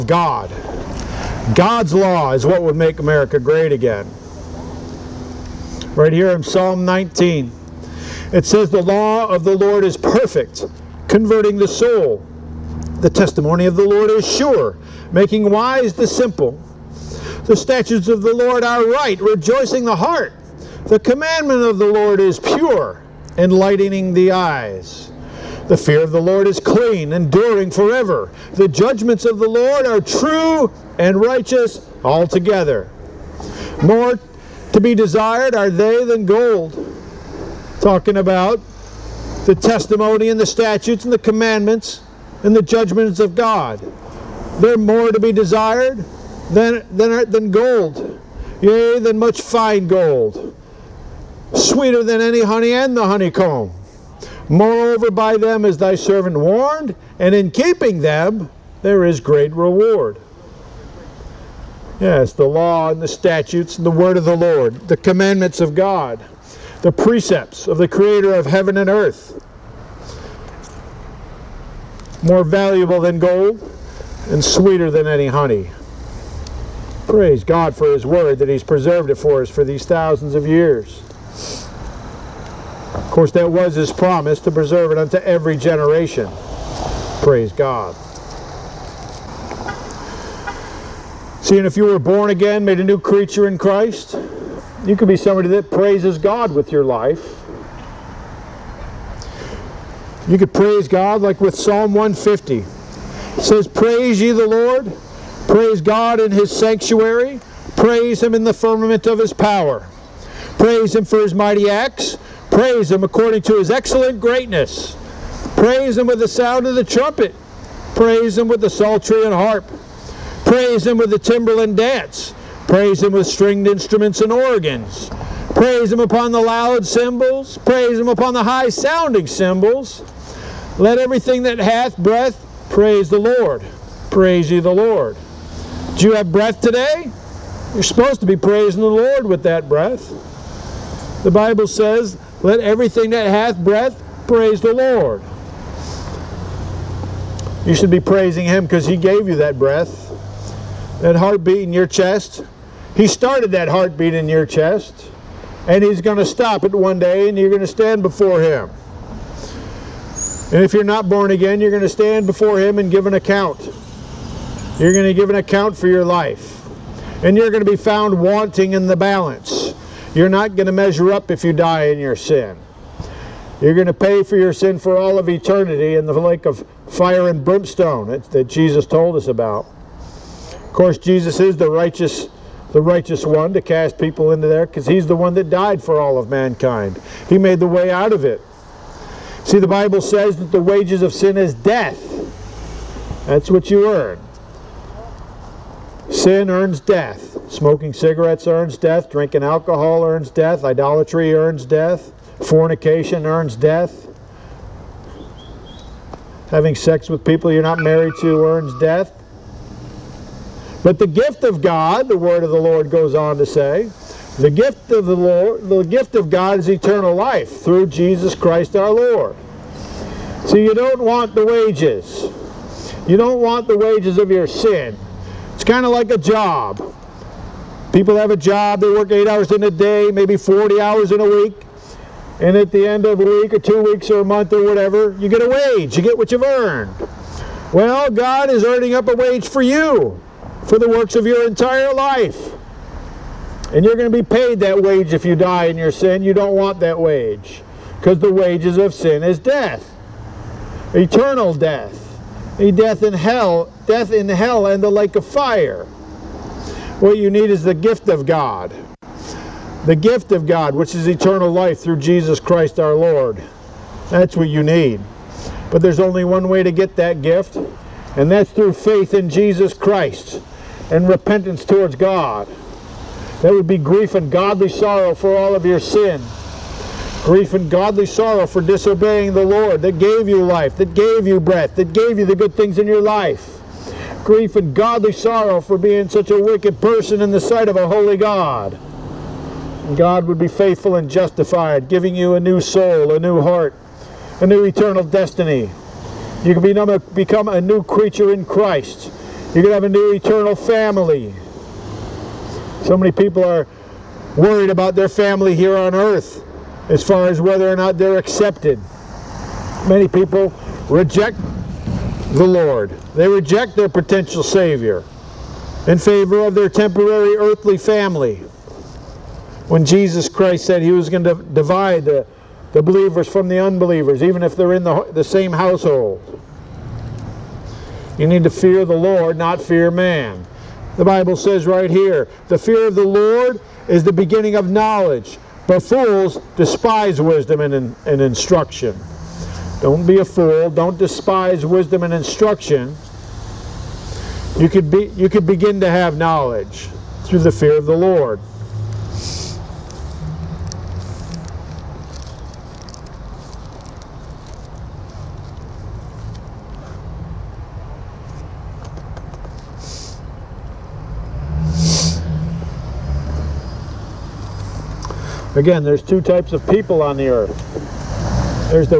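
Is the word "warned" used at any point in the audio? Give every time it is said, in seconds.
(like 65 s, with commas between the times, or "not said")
56 s.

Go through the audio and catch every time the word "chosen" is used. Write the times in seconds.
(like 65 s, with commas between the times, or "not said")
not said.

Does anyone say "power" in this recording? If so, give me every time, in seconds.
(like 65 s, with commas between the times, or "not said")
109 s.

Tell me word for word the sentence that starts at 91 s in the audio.
Seeing if you were born again, made a new creature in Christ, you could be somebody that praises God with your life.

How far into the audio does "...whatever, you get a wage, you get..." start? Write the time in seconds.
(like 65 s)
234 s.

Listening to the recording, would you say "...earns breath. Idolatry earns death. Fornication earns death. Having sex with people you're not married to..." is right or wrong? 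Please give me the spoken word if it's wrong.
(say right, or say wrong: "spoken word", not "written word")
wrong: "death", not "breath".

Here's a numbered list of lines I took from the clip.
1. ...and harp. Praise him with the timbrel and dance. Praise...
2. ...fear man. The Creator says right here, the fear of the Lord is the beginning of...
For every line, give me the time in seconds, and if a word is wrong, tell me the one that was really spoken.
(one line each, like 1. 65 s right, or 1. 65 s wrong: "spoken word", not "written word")
1. 119 s right
2. 329 s wrong: "Bible", not "Creator".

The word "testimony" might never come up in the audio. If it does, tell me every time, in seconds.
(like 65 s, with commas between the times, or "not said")
13 s, 39 s.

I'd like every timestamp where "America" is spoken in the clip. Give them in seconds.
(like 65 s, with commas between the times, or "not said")
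2 s.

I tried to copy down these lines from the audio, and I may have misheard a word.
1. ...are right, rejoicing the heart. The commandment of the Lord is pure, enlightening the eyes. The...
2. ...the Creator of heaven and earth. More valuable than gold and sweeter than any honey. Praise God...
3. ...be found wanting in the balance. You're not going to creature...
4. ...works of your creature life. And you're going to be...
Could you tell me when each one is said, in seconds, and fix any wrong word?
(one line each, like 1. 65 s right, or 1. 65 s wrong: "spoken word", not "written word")
1. 18 s right
2. 67 s right
3. 167 s wrong: "measure", not "creature"
4. 240 s wrong: "entire", not "creature".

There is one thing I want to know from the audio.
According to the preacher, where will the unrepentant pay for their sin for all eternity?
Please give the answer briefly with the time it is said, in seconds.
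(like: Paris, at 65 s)
Lake of fire and brimstone, at 176 s.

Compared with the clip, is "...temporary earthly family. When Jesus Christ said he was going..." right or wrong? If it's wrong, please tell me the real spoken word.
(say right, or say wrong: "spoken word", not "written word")
right.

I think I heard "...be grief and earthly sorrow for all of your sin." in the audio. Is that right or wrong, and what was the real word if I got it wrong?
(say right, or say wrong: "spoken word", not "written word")
wrong: "godly", not "earthly".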